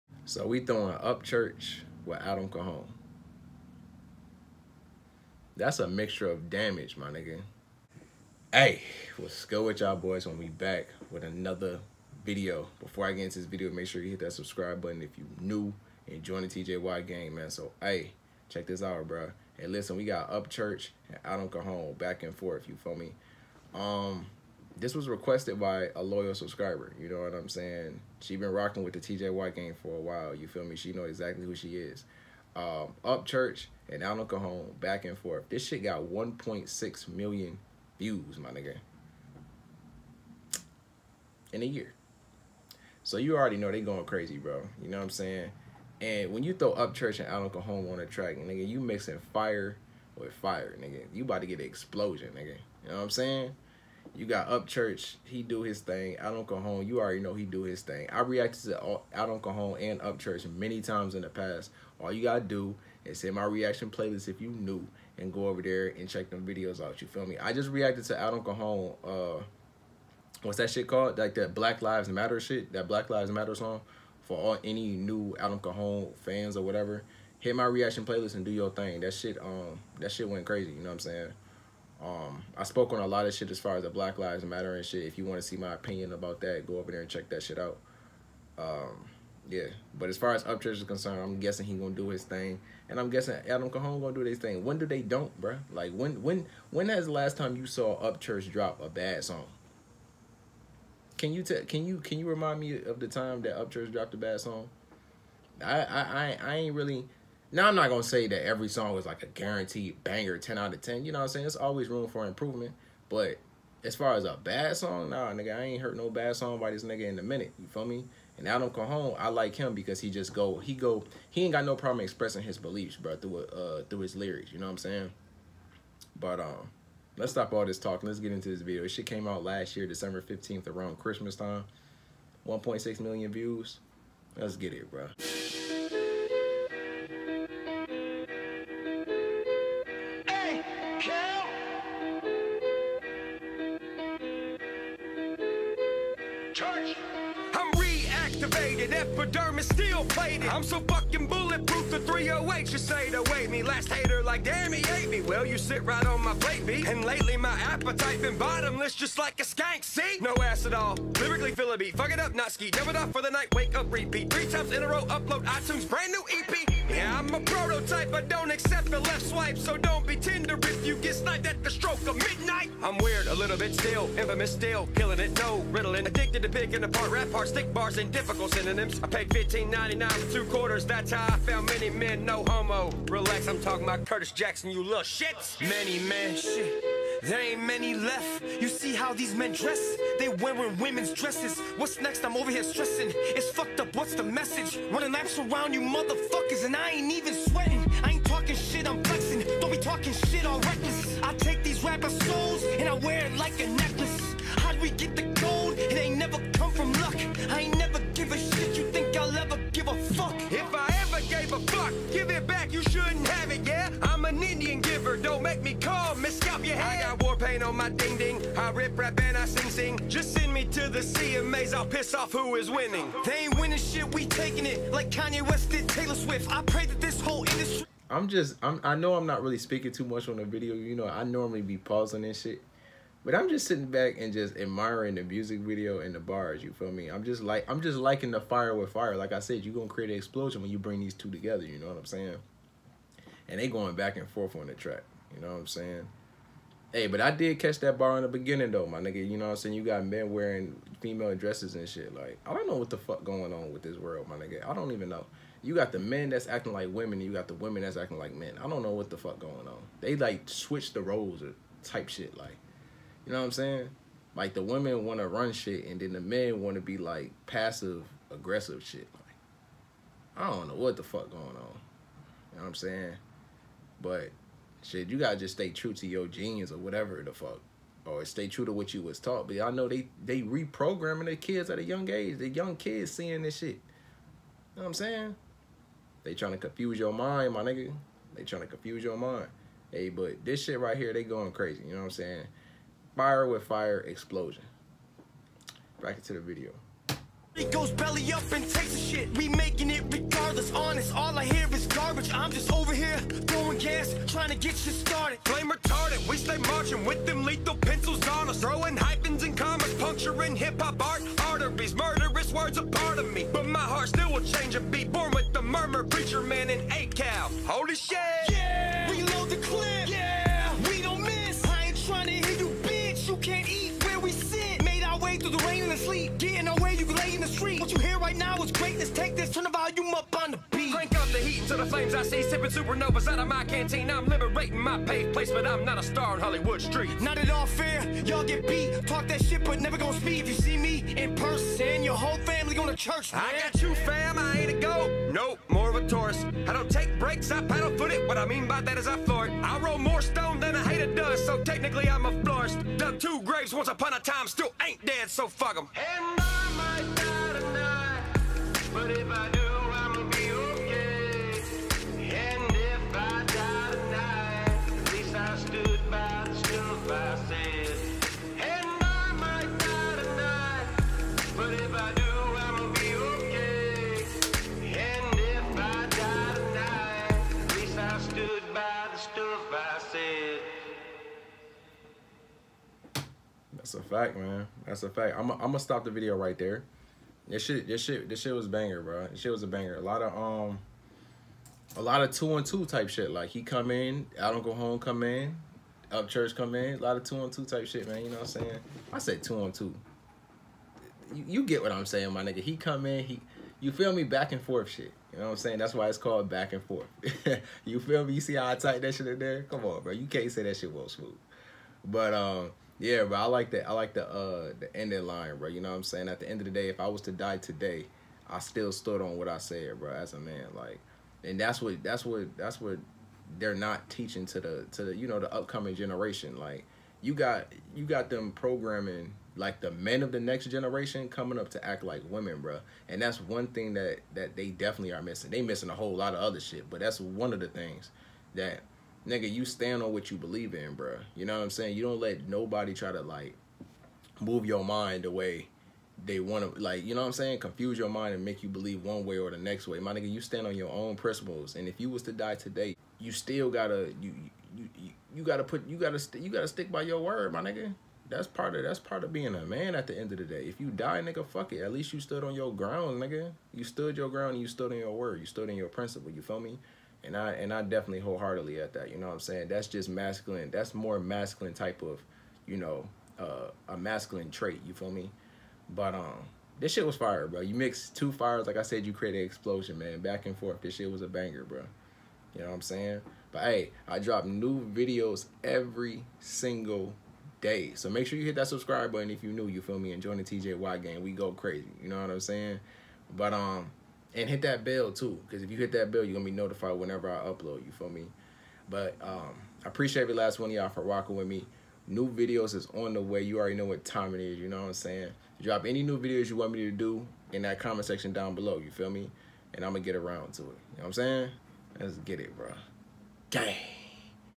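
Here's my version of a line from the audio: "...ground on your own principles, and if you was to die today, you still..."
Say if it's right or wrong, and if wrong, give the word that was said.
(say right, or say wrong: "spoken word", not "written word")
wrong: "stand", not "ground".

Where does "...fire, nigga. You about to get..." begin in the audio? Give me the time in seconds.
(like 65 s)
50 s.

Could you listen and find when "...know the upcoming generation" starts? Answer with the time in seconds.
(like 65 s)
425 s.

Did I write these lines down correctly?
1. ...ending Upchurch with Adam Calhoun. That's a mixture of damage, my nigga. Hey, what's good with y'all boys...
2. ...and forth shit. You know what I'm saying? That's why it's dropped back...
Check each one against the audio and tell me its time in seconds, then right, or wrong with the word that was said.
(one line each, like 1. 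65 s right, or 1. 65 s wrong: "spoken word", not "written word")
1. 0 s wrong: "throwing", not "ending"
2. 404 s wrong: "called", not "dropped".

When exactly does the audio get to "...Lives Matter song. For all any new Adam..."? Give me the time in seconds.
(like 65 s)
73 s.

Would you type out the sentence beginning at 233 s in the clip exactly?
But I'm just sitting back and just admiring the music video and the bars.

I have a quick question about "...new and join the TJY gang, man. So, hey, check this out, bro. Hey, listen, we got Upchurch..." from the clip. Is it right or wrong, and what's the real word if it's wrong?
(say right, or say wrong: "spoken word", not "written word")
right.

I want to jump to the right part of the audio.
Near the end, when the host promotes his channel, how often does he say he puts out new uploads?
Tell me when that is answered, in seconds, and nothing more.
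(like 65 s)
485 s.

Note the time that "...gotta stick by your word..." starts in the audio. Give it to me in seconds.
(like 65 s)
456 s.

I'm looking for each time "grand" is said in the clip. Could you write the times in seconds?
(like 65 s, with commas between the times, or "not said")
not said.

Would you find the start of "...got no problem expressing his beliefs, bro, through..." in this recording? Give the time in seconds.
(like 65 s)
121 s.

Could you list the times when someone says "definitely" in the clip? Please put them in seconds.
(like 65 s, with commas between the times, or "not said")
434 s, 467 s.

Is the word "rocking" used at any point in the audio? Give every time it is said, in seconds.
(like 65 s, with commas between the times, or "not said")
28 s, 501 s.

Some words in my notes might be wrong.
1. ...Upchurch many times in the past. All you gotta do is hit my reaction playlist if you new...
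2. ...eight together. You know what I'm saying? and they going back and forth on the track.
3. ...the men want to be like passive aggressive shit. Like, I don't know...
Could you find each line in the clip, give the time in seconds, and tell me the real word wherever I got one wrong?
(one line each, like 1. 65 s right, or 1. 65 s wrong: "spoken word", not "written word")
1. 60 s right
2. 241 s wrong: "two", not "eight"
3. 266 s right.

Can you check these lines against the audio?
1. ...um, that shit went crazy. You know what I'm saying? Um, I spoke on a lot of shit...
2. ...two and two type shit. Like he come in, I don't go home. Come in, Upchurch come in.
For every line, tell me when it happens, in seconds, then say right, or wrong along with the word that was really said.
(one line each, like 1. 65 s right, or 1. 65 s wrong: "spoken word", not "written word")
1. 79 s right
2. 392 s right.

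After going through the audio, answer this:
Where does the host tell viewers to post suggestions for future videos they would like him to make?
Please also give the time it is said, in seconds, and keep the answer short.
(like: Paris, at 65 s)
comment section, at 507 s.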